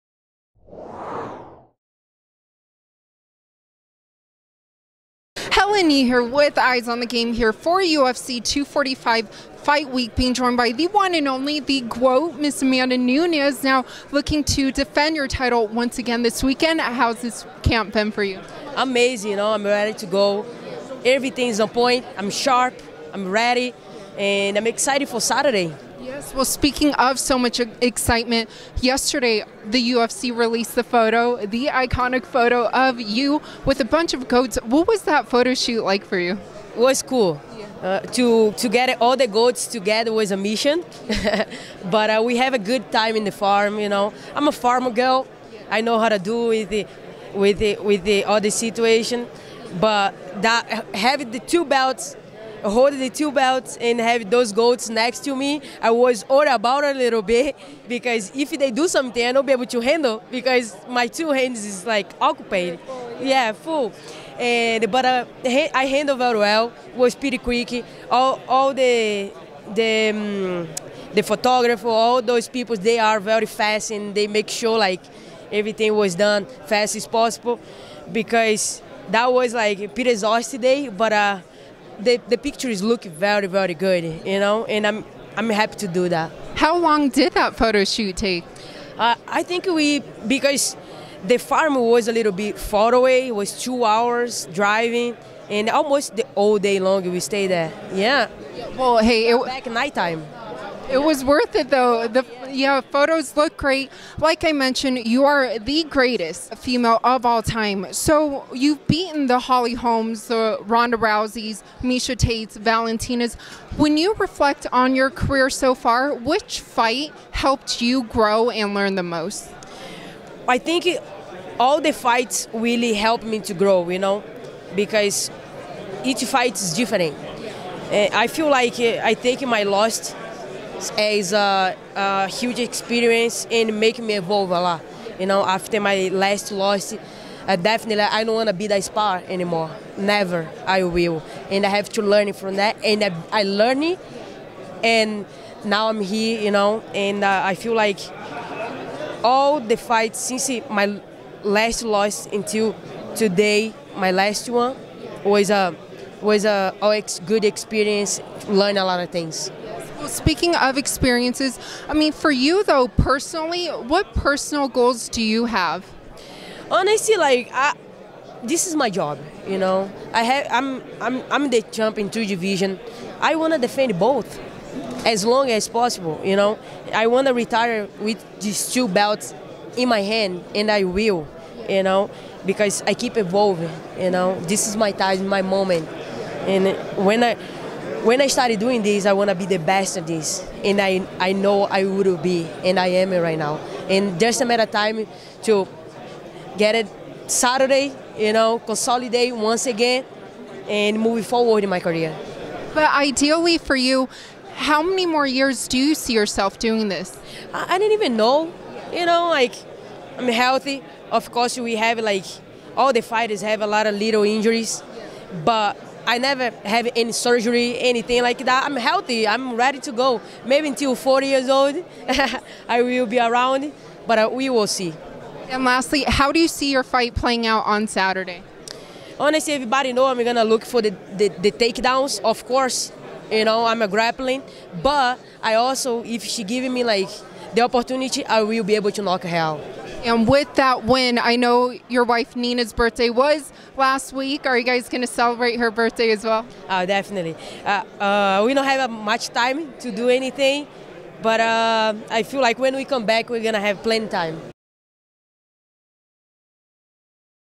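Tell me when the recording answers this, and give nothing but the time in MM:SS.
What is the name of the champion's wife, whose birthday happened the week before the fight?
04:02.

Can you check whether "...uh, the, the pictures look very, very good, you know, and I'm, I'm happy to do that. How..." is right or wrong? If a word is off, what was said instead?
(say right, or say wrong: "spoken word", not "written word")
right.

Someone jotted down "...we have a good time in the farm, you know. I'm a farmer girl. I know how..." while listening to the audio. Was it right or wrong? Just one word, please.
right.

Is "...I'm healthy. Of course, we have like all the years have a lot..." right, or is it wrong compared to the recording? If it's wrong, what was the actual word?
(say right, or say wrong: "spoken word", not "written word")
wrong: "fighters", not "years".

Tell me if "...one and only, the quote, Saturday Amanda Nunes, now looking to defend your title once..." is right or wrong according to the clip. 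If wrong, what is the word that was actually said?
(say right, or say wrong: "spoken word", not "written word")
wrong: "Miss", not "Saturday".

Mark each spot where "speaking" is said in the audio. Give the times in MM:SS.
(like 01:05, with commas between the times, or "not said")
00:26, 02:40.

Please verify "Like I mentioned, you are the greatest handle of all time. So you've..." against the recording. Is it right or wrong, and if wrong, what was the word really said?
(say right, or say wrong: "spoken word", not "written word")
wrong: "female", not "handle".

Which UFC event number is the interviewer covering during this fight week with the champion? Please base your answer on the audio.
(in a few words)
UFC 245.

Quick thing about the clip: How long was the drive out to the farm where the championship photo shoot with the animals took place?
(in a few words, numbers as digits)
2 hours.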